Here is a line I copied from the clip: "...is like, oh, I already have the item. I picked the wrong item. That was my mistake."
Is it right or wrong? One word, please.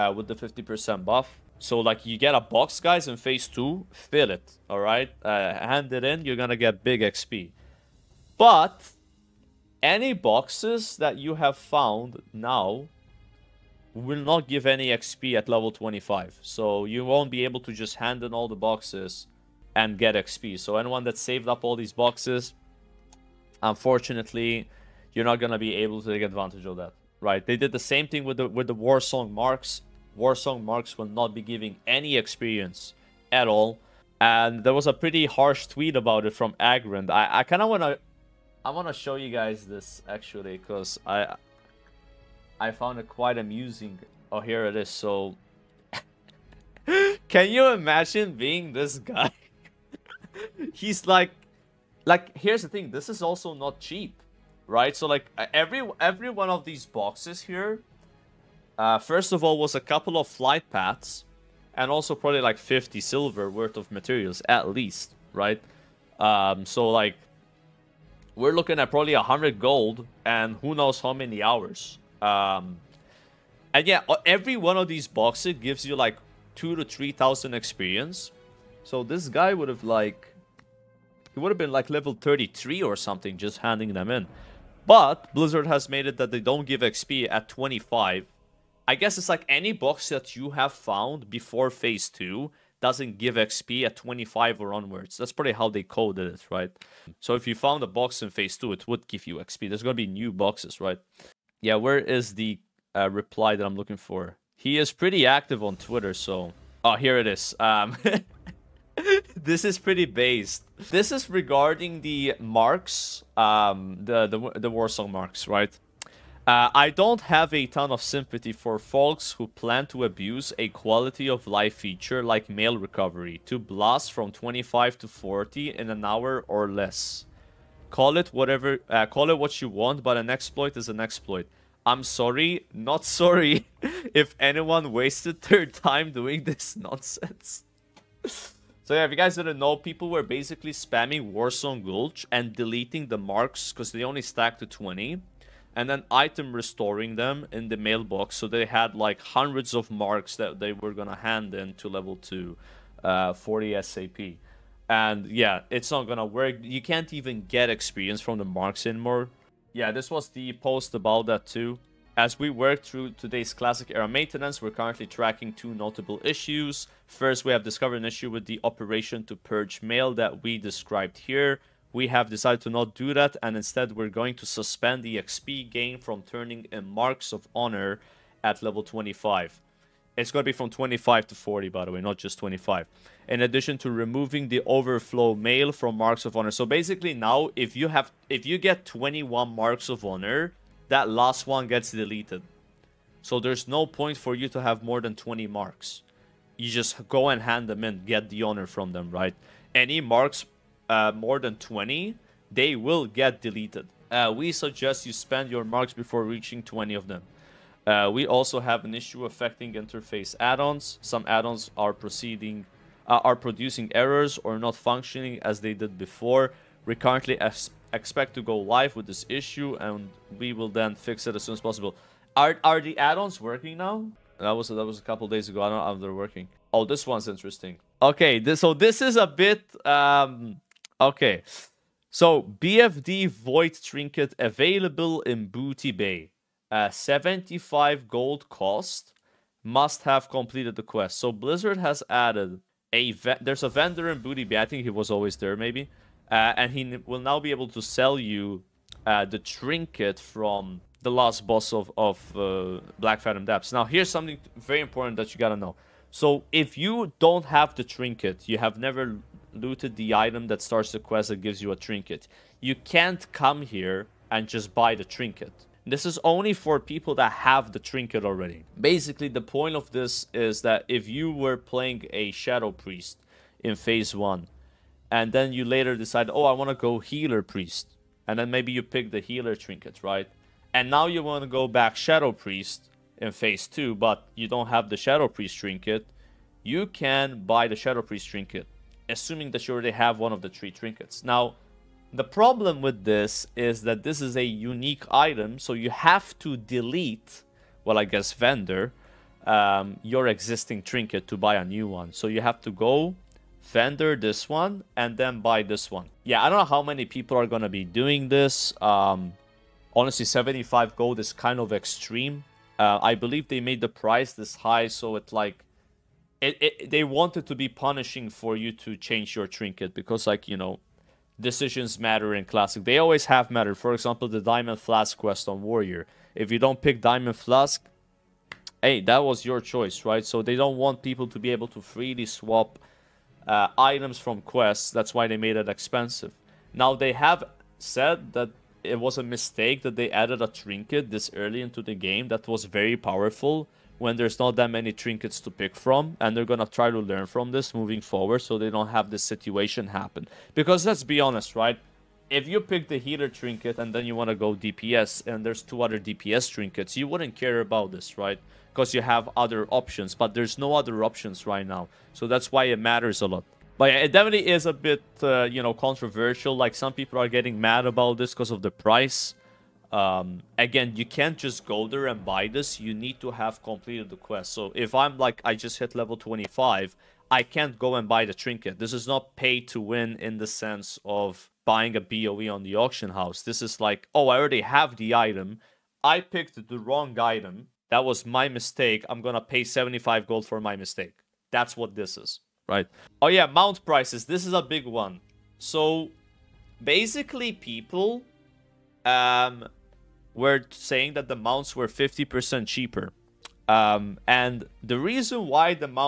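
right.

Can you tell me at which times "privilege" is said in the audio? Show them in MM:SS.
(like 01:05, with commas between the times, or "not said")
not said.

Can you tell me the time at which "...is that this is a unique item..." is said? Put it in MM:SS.
04:53.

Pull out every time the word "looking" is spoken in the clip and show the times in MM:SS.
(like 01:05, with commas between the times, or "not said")
01:08, 01:43.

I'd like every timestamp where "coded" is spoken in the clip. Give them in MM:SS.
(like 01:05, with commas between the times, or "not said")
01:35.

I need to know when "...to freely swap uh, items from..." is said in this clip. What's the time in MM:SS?
05:31.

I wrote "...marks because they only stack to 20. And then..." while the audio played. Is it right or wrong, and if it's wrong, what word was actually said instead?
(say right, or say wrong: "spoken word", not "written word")
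right.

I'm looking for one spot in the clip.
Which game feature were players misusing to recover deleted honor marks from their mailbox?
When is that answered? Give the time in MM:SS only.
02:02.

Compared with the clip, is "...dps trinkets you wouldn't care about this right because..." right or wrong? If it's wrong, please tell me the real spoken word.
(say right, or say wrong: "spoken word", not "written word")
right.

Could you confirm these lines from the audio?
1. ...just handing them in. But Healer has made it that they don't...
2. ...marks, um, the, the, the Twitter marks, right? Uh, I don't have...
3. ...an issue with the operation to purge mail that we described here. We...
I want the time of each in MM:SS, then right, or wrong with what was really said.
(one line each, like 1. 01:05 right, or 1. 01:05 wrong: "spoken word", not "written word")
1. 01:23 wrong: "Blizzard", not "Healer"
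2. 01:52 wrong: "Song", not "Twitter"
3. 02:47 right.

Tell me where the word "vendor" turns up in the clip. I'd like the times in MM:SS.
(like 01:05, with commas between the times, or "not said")
04:03, 04:58, 05:03.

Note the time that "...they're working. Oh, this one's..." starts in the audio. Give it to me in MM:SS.
03:46.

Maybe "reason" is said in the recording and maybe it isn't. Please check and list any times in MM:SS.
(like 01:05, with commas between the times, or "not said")
06:44.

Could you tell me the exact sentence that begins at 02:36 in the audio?
You can't even get experience from the marks anymore.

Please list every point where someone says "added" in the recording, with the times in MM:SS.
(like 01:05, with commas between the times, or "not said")
04:02, 05:40.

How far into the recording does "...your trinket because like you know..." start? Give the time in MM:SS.
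05:19.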